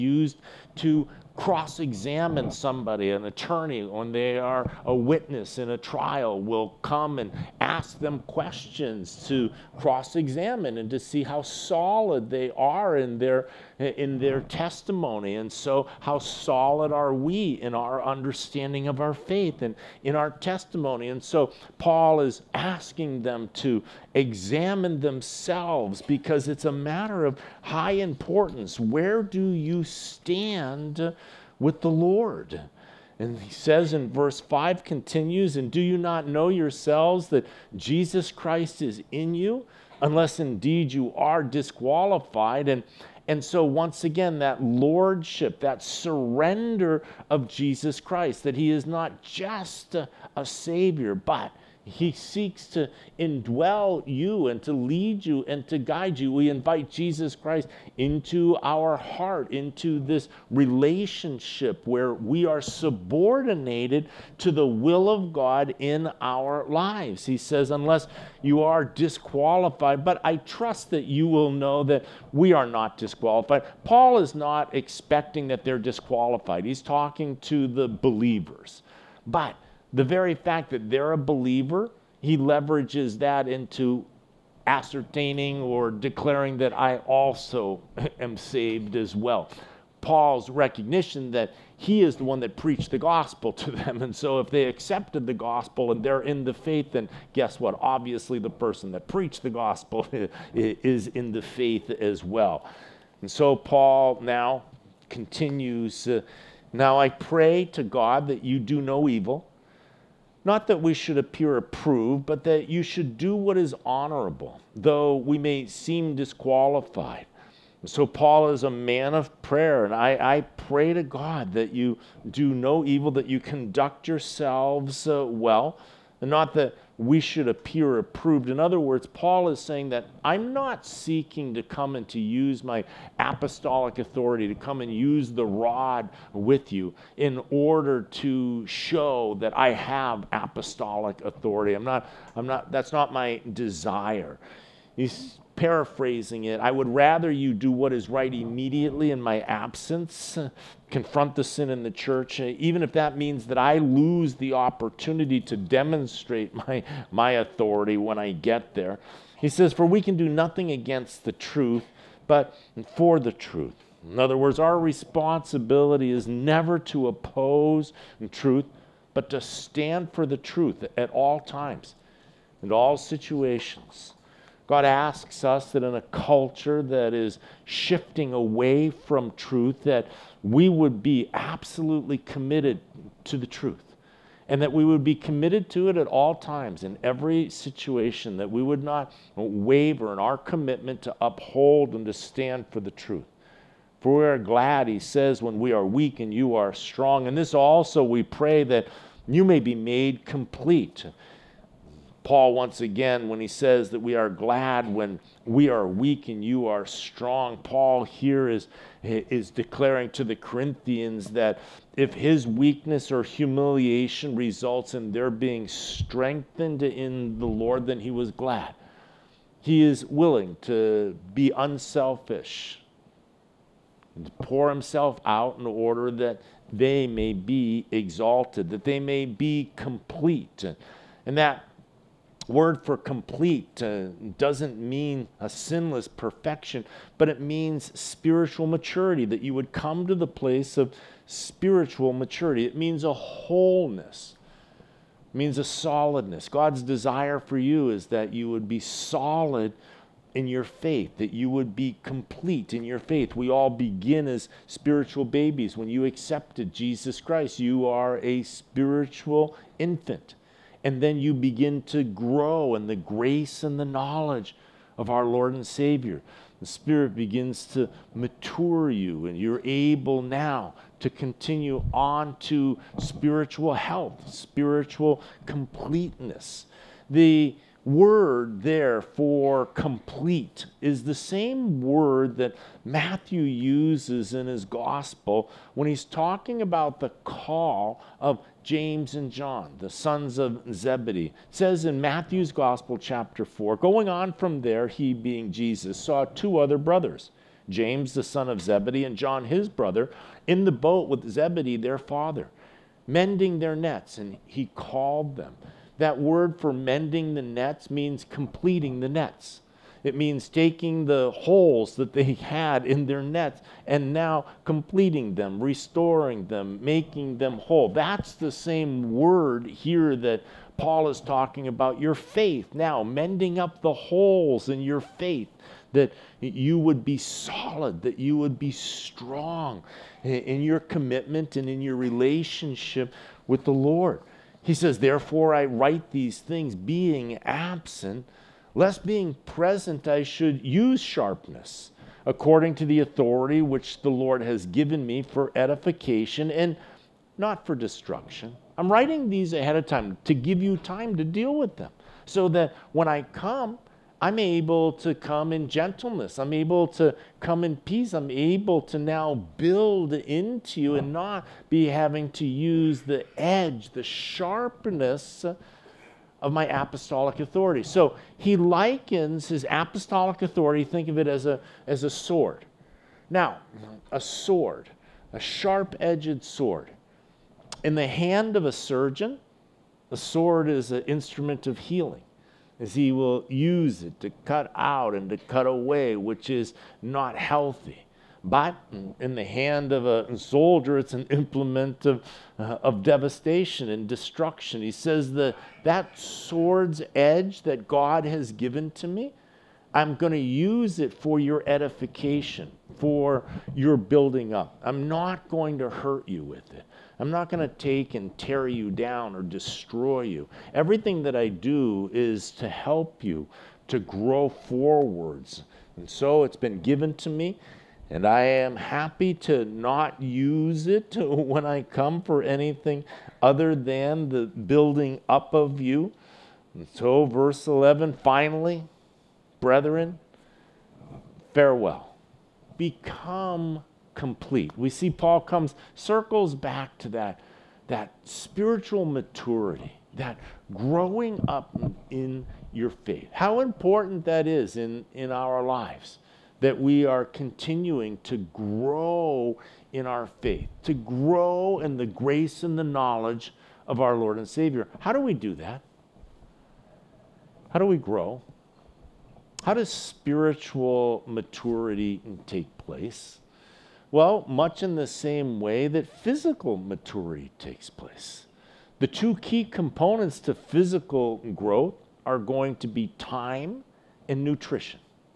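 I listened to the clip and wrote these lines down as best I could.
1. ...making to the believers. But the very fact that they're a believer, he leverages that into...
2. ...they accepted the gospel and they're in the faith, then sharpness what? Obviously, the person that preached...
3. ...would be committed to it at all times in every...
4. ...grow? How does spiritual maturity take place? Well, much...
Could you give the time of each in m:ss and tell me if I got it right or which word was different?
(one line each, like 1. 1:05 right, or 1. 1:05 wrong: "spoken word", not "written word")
1. 1:16 wrong: "talking", not "making"
2. 1:34 wrong: "guess", not "sharpness"
3. 3:04 right
4. 7:37 right.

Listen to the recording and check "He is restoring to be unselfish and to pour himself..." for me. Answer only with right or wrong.
wrong.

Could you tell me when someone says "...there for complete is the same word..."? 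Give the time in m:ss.
4:38.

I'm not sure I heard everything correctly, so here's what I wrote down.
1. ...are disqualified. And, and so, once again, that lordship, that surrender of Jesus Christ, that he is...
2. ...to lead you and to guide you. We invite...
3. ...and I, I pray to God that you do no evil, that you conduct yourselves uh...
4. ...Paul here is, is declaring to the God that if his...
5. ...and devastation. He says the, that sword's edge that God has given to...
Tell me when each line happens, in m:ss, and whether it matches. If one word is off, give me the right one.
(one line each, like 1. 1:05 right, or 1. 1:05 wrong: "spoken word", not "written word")
1. 0:41 right
2. 0:54 right
3. 1:59 right
4. 3:27 wrong: "Corinthians", not "God"
5. 6:33 wrong: "destruction", not "devastation".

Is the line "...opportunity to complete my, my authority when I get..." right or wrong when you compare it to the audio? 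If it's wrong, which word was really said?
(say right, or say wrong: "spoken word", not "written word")
wrong: "demonstrate", not "complete".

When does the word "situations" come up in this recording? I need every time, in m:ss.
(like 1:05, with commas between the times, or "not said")
2:52, 3:07.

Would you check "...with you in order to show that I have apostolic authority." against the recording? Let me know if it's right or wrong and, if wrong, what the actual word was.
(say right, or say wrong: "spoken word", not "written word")
right.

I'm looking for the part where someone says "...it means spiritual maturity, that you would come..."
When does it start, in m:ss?
3:57.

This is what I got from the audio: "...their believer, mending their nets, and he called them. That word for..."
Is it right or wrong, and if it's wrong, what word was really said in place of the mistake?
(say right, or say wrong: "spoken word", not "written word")
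wrong: "father", not "believer".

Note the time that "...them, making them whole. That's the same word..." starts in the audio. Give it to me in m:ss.
5:16.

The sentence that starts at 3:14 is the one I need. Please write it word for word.
For we are glad, he says, when we are weak and you are strong.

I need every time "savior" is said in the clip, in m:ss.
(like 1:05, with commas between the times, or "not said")
0:50, 4:25, 7:34.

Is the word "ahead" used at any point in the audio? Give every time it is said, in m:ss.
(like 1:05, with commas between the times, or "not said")
5:49.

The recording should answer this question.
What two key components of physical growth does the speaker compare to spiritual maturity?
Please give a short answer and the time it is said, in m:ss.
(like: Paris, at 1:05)
Time and nutrition, at 7:53.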